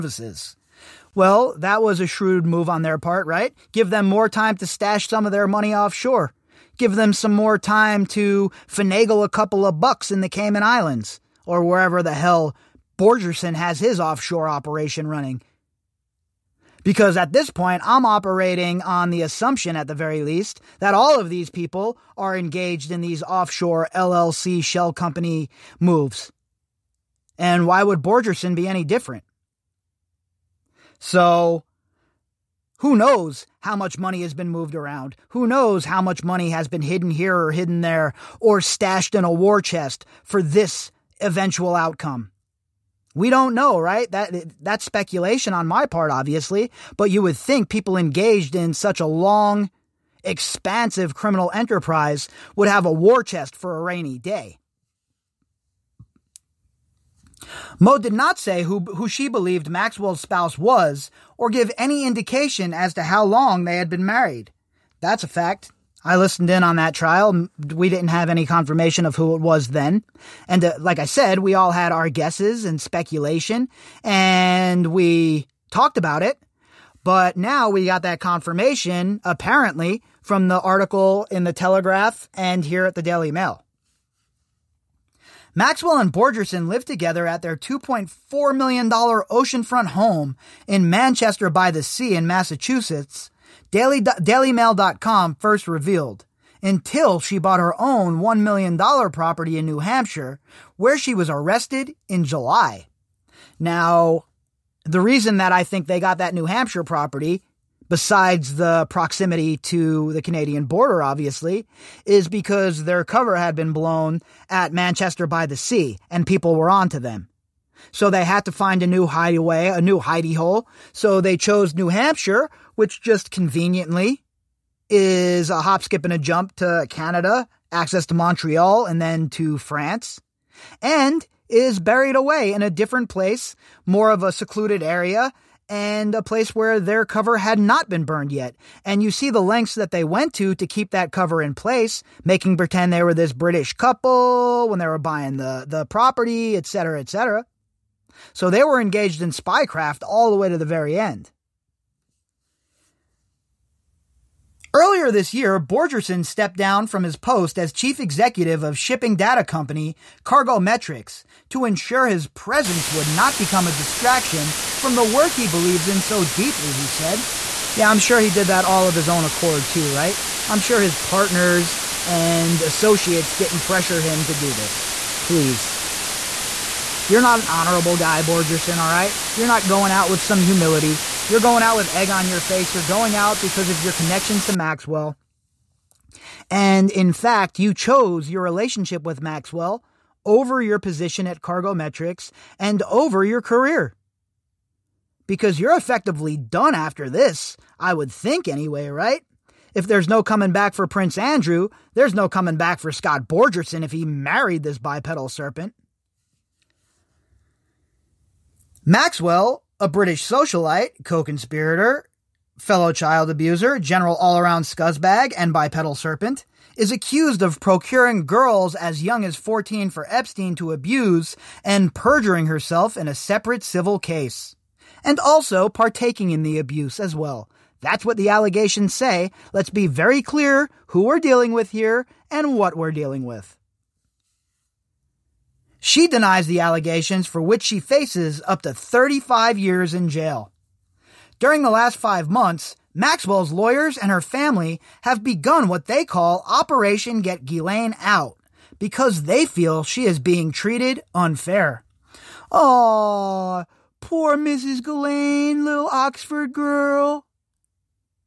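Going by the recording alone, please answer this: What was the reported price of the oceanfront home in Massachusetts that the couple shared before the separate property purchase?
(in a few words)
$2.4 million.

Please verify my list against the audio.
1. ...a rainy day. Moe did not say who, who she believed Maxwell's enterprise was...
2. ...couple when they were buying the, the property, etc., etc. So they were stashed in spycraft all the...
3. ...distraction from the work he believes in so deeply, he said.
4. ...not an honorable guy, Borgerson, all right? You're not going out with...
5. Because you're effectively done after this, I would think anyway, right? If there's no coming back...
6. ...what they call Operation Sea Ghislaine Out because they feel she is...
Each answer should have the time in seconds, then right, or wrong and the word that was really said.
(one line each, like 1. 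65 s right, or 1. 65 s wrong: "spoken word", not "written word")
1. 53 s wrong: "spouse", not "enterprise"
2. 143 s wrong: "engaged", not "stashed"
3. 163 s right
4. 177 s right
5. 195 s right
6. 245 s wrong: "Get", not "Sea".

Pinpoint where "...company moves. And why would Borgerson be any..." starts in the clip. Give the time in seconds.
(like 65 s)
24 s.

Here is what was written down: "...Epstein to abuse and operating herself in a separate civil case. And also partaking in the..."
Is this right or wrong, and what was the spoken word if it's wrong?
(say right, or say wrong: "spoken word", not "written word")
wrong: "perjuring", not "operating".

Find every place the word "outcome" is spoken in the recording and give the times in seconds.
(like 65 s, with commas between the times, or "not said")
41 s.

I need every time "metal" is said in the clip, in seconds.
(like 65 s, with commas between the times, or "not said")
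not said.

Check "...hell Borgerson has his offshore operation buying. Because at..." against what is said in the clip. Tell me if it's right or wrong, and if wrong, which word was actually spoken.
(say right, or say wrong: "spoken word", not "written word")
wrong: "running", not "buying".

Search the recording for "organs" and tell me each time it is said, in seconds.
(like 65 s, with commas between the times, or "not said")
not said.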